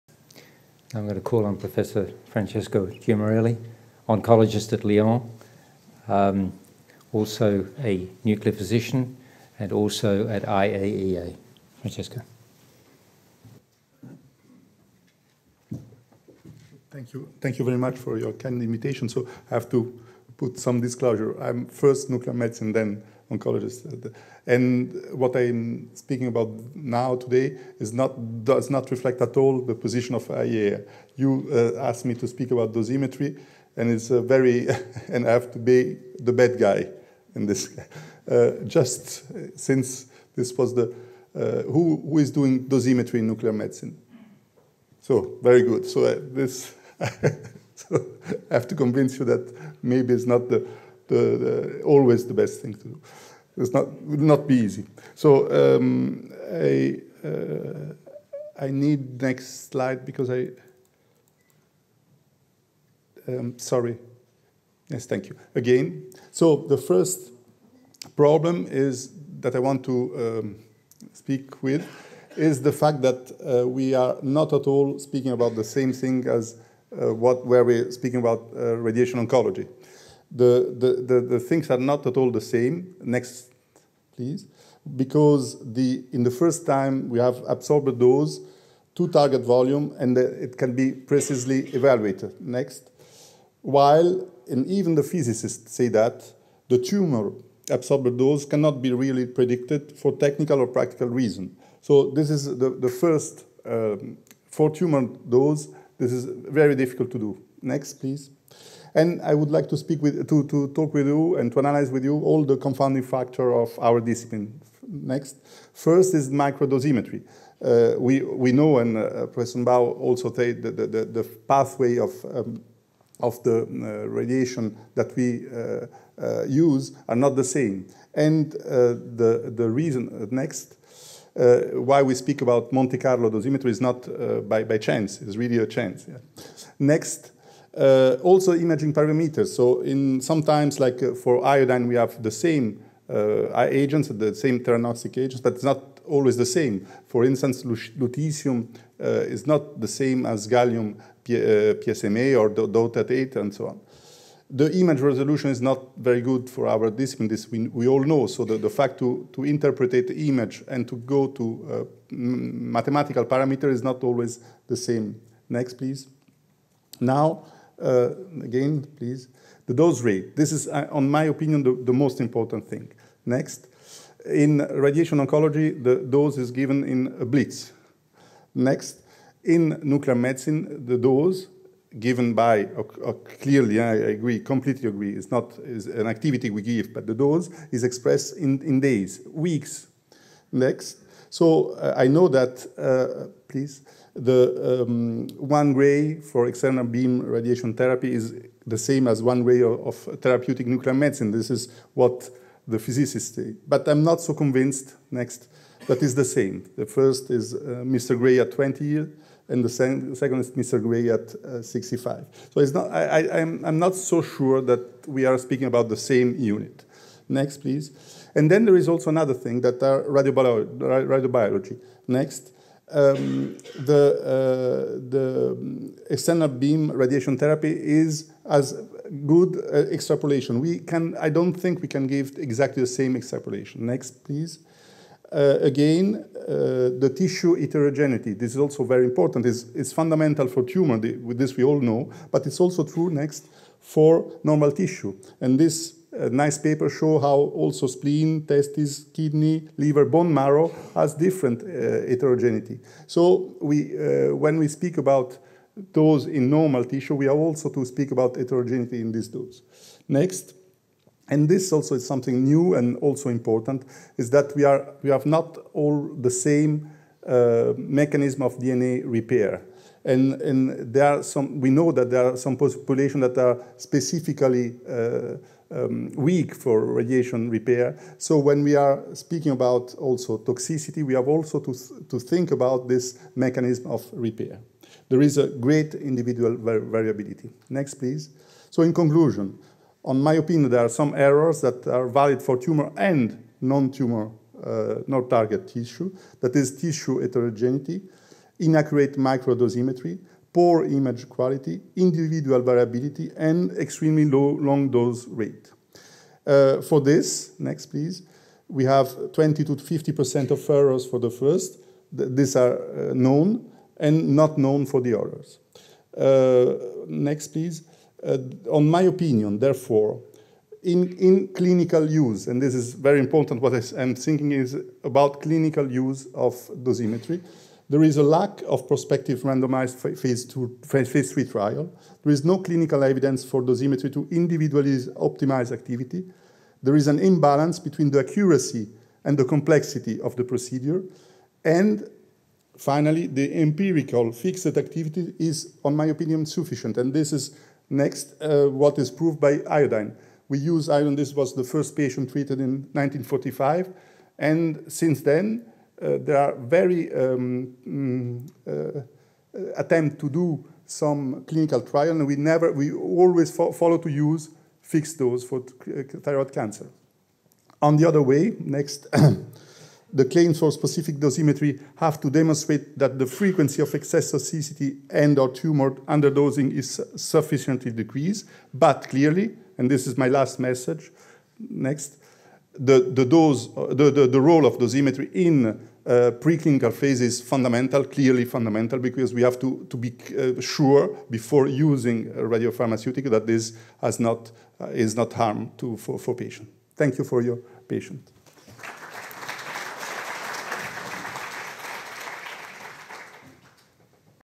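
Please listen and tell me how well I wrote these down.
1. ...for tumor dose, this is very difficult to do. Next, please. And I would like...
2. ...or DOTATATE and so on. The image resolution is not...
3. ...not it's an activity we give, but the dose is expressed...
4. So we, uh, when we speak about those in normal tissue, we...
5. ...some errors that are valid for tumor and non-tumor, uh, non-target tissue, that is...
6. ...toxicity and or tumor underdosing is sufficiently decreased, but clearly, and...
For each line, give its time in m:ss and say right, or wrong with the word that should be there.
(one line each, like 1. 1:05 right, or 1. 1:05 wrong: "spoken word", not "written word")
1. 1:44 right
2. 2:32 right
3. 3:05 right
4. 4:13 right
5. 4:50 right
6. 6:14 right.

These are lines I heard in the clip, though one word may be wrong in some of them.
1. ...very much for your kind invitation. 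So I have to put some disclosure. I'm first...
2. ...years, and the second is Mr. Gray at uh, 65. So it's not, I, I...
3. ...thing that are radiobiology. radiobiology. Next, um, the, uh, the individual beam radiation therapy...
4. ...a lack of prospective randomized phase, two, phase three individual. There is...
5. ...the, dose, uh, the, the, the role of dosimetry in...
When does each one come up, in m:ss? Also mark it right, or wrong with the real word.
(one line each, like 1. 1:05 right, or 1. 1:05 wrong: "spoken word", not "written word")
1. 0:17 right
2. 3:28 right
3. 3:39 wrong: "external", not "individual"
4. 5:28 wrong: "trial", not "individual"
5. 6:23 right.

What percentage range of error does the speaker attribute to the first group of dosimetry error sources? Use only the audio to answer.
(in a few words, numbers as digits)
20 to 50%.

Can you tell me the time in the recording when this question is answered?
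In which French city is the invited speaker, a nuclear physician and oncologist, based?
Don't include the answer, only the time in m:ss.
0:04.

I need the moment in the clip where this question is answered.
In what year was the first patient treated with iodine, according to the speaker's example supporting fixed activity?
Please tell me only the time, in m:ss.
5:52.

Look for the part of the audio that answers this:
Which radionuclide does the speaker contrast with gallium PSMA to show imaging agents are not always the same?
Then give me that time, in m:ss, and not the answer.
2:27.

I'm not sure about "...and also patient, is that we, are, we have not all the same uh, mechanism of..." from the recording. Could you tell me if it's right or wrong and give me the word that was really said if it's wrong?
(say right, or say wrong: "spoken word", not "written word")
wrong: "important", not "patient".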